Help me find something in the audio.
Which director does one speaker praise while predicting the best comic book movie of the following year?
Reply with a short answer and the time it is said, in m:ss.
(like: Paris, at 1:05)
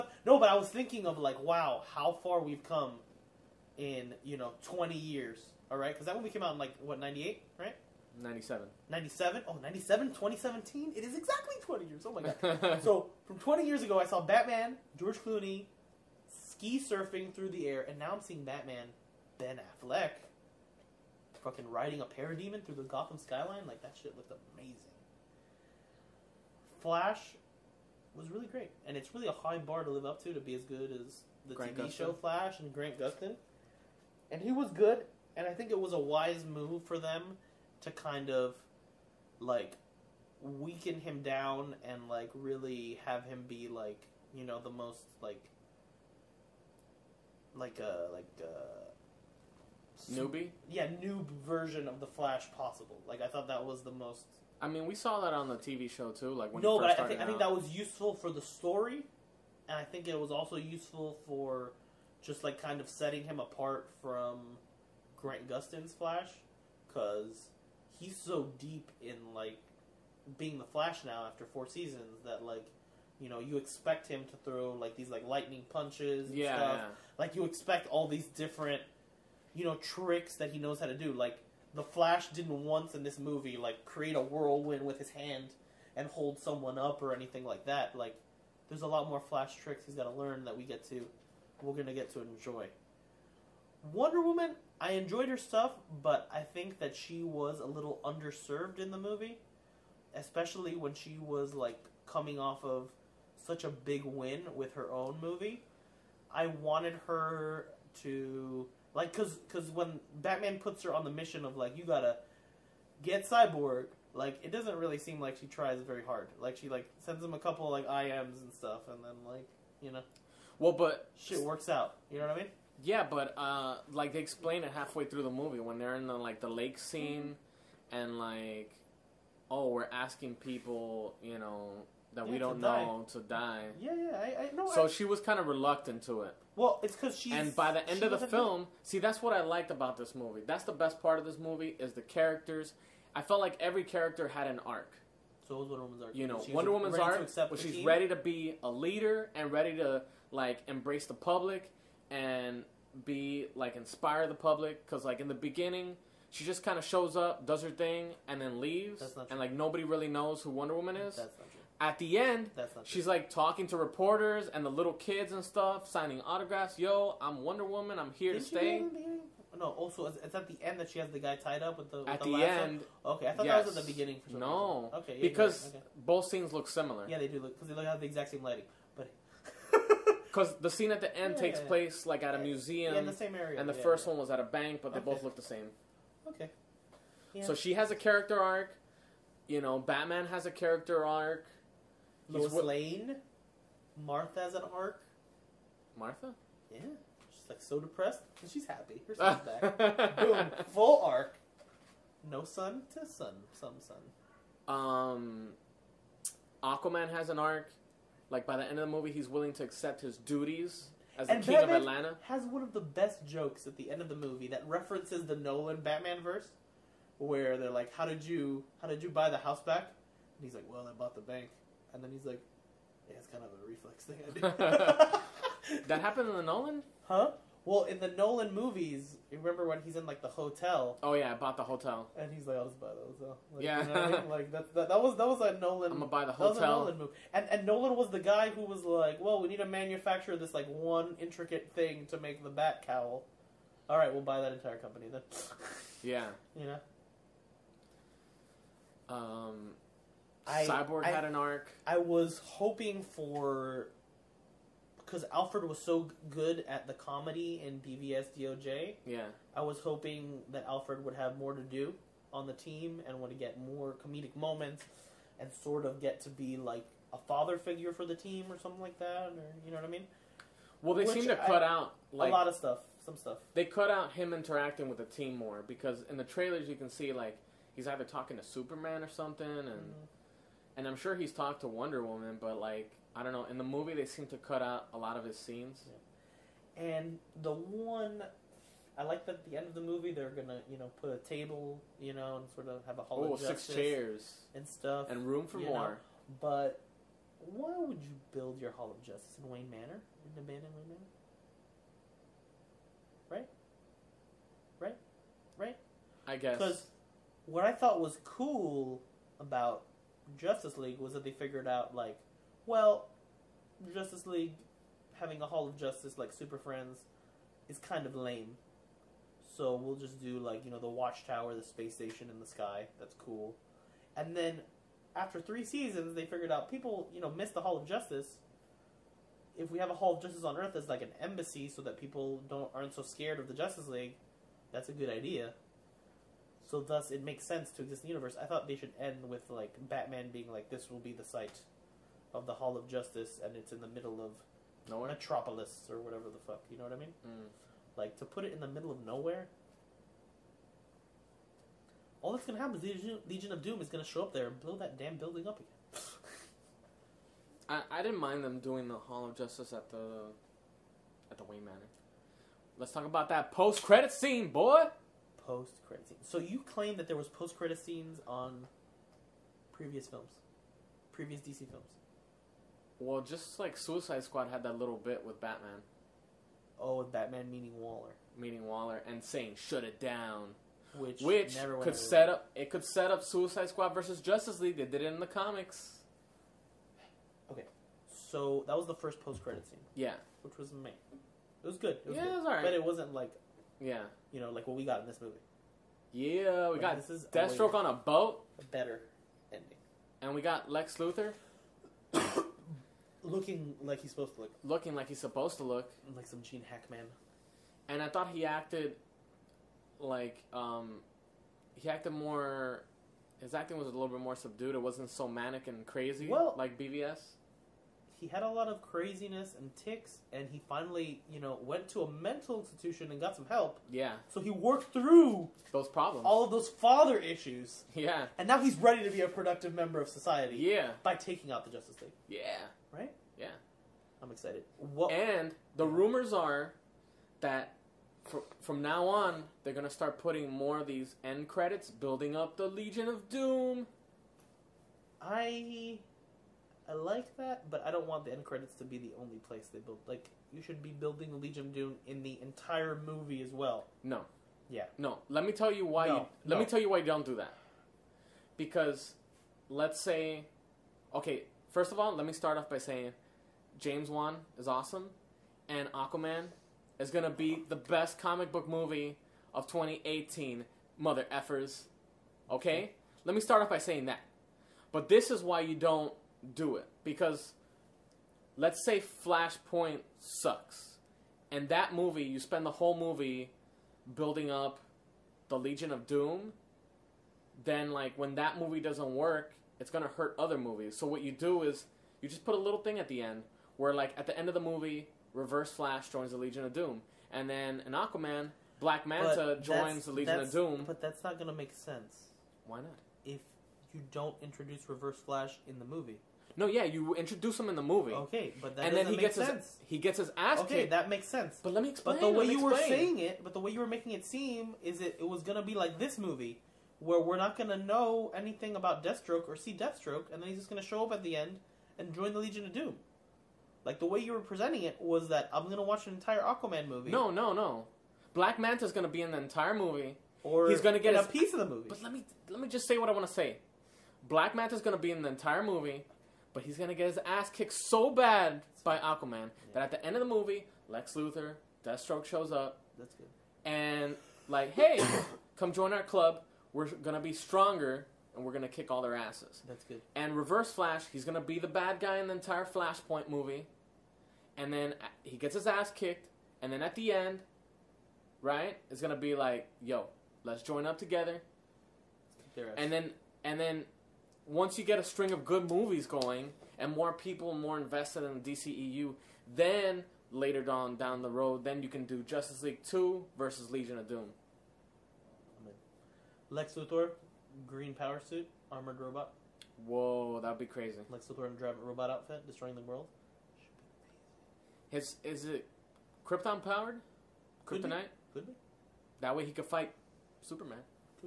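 James Wan, at 7:43.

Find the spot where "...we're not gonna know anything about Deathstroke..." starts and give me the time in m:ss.
8:37.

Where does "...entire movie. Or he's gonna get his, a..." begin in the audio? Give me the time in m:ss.
8:49.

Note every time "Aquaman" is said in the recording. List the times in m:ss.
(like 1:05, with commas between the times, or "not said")
3:26, 7:45, 8:17, 8:46, 8:58.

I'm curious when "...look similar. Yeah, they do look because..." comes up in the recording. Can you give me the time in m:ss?
2:56.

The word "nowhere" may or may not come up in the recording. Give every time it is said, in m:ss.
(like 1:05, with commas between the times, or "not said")
5:44, 5:49.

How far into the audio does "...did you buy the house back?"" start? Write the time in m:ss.
3:38.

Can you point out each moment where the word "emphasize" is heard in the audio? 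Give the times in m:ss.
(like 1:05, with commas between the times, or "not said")
not said.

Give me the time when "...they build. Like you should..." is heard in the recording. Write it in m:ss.
7:29.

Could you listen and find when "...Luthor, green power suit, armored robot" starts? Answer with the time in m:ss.
9:36.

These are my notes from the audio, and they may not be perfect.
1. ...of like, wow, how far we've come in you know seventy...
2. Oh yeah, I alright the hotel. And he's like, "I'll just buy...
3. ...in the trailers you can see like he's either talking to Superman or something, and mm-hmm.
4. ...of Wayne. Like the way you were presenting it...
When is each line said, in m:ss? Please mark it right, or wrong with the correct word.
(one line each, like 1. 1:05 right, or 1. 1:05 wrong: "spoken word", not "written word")
1. 0:01 wrong: "twenty", not "seventy"
2. 3:51 wrong: "bought", not "alright"
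3. 4:36 right
4. 8:42 wrong: "Doom", not "Wayne".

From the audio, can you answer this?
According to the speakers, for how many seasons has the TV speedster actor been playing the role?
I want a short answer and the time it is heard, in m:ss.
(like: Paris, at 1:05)
4, at 1:11.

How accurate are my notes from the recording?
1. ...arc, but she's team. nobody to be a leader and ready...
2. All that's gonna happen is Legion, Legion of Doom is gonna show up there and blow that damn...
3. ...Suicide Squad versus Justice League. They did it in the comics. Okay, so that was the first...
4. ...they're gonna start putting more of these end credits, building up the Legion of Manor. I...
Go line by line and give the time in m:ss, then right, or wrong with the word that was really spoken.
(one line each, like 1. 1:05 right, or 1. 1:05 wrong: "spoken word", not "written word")
1. 2:26 wrong: "ready", not "nobody"
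2. 5:52 right
3. 6:23 right
4. 7:19 wrong: "Doom", not "Manor".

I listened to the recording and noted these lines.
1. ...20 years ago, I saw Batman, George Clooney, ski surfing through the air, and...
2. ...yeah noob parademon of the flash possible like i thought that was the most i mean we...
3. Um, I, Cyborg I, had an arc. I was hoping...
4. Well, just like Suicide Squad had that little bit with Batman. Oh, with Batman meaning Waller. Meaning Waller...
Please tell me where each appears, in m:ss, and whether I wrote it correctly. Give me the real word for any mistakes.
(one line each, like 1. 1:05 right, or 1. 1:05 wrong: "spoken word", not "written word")
1. 0:13 right
2. 0:50 wrong: "version", not "parademon"
3. 4:09 right
4. 6:13 right.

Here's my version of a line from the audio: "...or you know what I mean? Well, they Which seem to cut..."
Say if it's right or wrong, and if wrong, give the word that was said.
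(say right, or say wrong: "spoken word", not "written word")
right.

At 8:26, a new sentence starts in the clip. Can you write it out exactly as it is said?
No, yeah, you introduce him in the movie.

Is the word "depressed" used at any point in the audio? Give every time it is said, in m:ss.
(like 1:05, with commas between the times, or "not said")
3:17.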